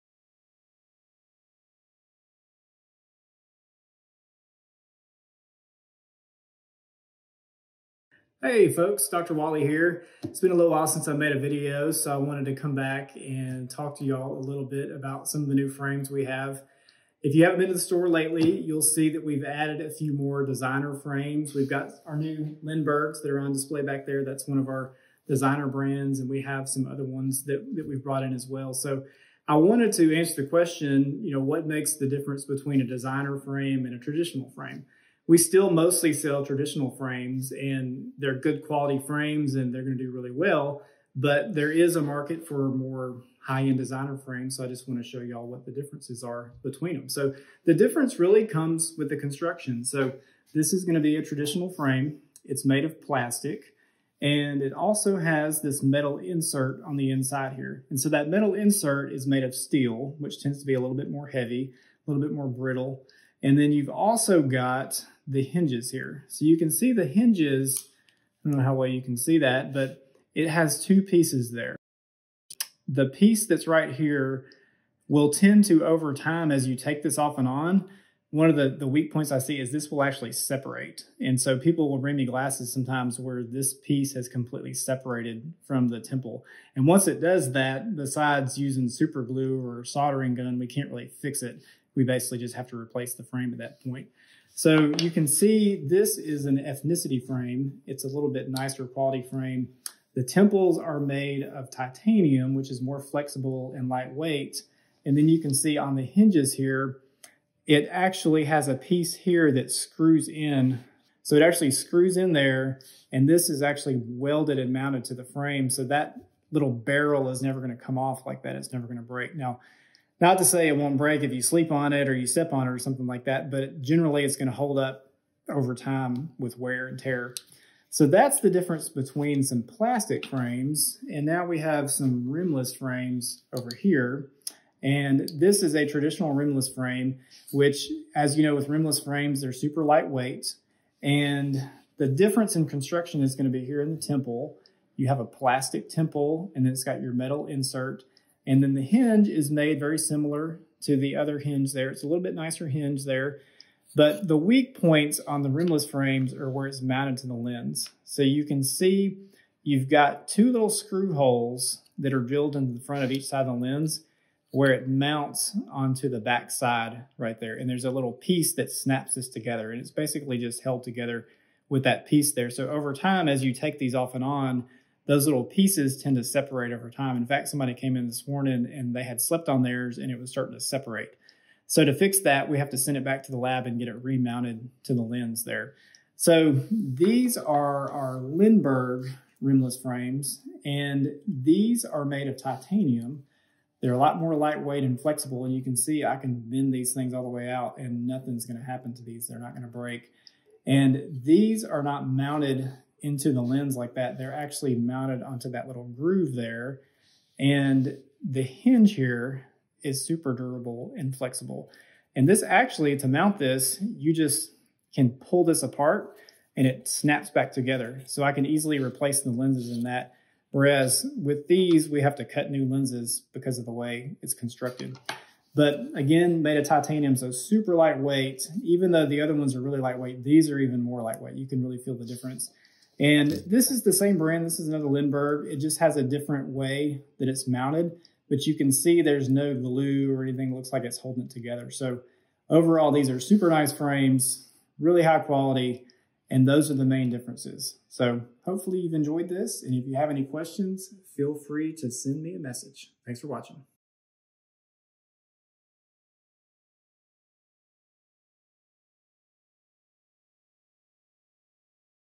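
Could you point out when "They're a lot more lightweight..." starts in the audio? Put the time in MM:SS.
03:13.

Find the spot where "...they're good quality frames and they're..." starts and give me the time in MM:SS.
00:38.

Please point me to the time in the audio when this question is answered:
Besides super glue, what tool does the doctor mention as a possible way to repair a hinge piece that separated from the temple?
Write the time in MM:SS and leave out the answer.
01:29.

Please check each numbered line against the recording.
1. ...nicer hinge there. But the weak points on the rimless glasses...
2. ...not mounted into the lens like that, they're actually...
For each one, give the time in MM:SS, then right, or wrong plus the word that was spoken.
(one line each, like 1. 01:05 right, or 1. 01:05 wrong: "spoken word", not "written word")
1. 02:32 wrong: "frames", not "glasses"
2. 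03:21 right.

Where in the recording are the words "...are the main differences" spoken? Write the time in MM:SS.
04:06.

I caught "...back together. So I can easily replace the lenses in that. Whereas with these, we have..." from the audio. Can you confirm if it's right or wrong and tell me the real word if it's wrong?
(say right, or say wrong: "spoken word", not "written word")
right.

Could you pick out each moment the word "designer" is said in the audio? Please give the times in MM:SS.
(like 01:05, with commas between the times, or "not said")
00:20, 00:25, 00:32, 00:43.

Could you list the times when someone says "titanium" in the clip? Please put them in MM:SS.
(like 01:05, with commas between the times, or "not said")
01:41, 03:12, 03:46.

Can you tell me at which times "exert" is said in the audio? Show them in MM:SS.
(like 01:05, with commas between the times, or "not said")
not said.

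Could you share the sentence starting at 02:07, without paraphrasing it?
So that's the difference between some plastic frames.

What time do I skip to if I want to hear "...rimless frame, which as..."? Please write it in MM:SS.
02:16.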